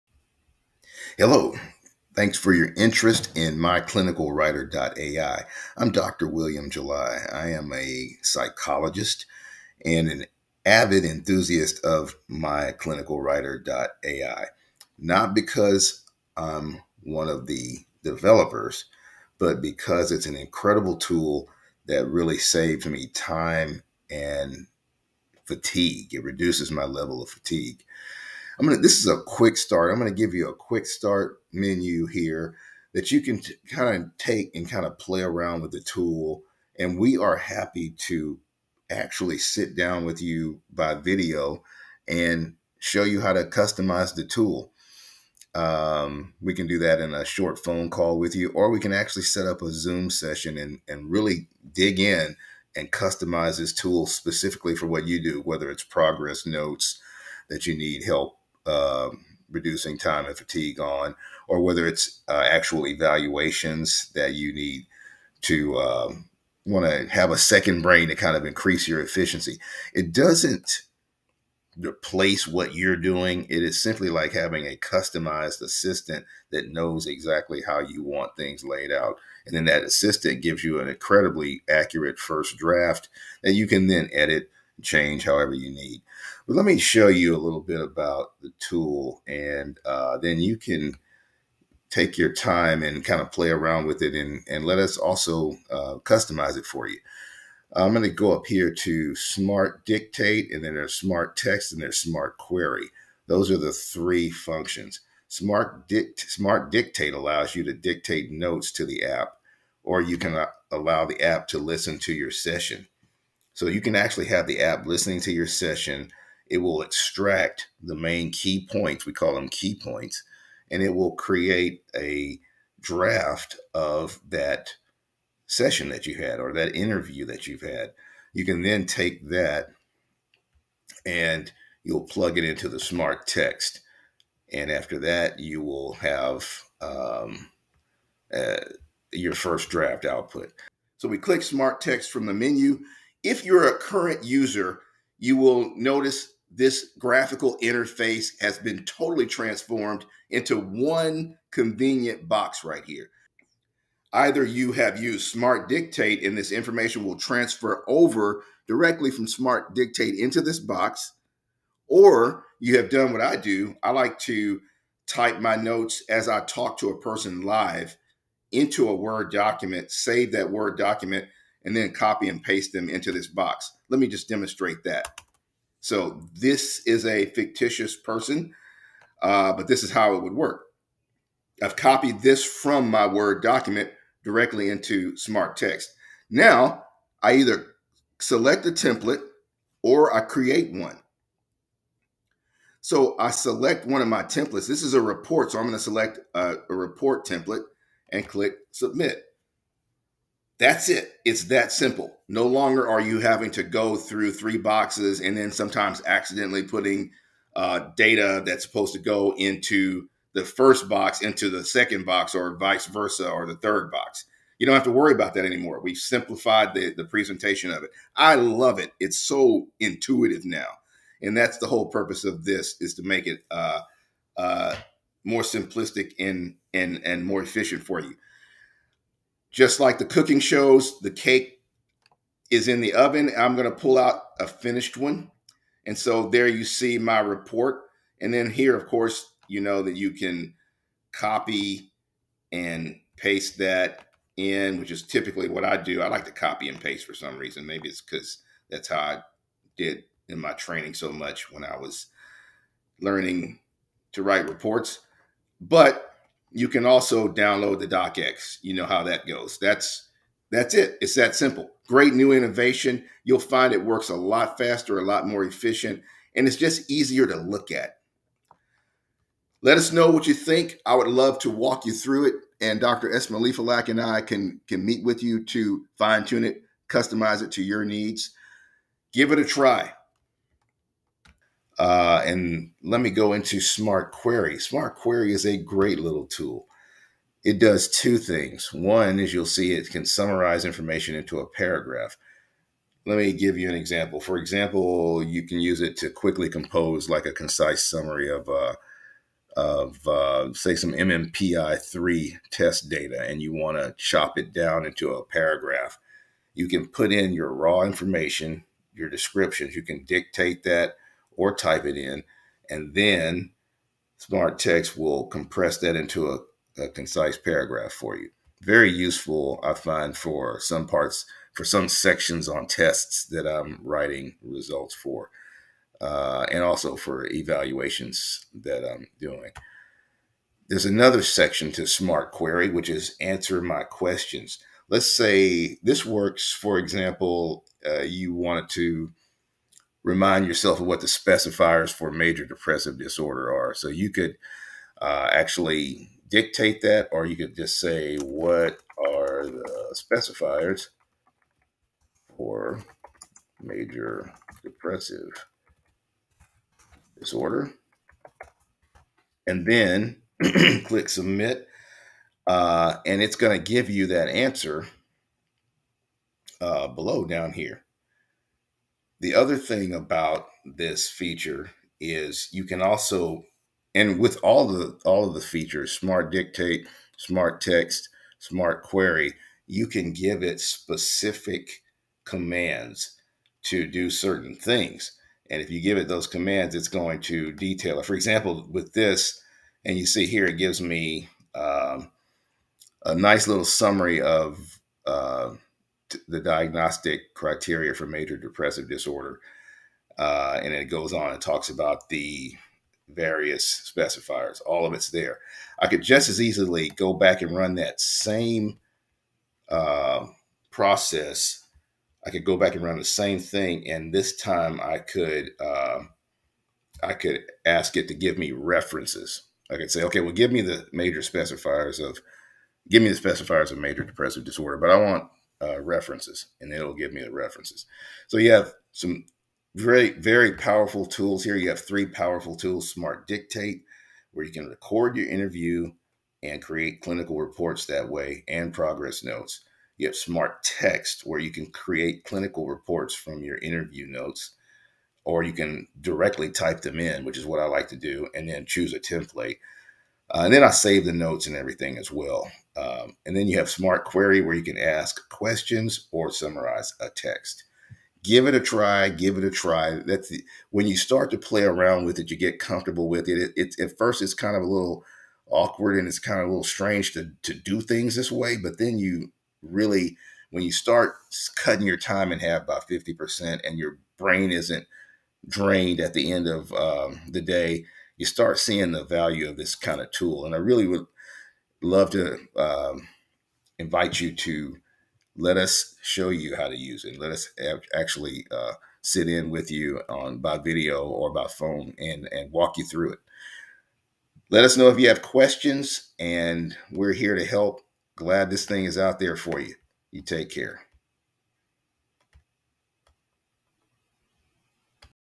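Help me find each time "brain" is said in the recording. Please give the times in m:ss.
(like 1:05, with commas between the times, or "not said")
1:07, 7:54.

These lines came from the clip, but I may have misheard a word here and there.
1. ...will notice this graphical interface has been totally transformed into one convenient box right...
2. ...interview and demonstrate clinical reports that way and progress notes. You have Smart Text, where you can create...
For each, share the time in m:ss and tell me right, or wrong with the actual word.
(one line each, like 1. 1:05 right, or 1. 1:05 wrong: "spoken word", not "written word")
1. 2:25 right
2. 7:15 wrong: "create", not "demonstrate".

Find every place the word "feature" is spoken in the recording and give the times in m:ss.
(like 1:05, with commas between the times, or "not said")
6:11, 6:15.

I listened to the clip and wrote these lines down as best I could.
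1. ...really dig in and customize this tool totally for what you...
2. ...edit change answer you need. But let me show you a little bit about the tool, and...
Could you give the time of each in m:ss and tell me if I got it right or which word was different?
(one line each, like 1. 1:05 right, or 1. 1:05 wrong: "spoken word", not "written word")
1. 0:51 wrong: "specifically", not "totally"
2. 1:24 wrong: "however", not "answer".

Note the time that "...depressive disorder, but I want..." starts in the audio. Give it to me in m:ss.
7:04.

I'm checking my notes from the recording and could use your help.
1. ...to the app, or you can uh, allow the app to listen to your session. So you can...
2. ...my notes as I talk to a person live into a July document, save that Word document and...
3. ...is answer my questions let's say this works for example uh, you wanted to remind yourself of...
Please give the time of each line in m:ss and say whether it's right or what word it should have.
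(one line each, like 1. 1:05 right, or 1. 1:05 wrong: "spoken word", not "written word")
1. 1:48 right
2. 2:45 wrong: "Word", not "July"
3. 5:32 right.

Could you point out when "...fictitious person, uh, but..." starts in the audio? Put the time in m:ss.
2:57.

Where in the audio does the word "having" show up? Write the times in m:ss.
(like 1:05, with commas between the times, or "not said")
1:14, 3:23.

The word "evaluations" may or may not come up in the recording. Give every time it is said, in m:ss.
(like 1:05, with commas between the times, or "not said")
1:02, 5:27.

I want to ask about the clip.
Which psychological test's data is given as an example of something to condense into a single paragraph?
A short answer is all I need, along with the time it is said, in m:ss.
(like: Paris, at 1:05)
MMPI-3, at 5:00.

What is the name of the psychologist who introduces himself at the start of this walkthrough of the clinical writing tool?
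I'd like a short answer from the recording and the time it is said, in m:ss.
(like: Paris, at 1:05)
William July, at 0:06.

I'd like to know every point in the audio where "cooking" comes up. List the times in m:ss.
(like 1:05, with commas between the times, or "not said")
3:50.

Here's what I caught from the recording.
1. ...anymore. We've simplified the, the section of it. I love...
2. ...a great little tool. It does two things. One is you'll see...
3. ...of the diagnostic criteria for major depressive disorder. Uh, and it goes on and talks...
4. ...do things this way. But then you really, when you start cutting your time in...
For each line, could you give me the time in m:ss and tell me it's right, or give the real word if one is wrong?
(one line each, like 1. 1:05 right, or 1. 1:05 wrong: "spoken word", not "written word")
1. 3:35 wrong: "presentation", not "section"
2. 4:45 right
3. 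6:34 right
4. 7:47 right.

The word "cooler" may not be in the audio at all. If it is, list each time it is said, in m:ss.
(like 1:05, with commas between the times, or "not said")
not said.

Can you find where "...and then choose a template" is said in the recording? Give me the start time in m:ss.
7:28.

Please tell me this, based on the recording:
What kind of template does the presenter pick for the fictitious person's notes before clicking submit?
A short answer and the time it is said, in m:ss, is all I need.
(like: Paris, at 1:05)
report template, at 3:16.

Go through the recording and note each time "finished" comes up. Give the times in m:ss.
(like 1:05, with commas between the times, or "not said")
3:54.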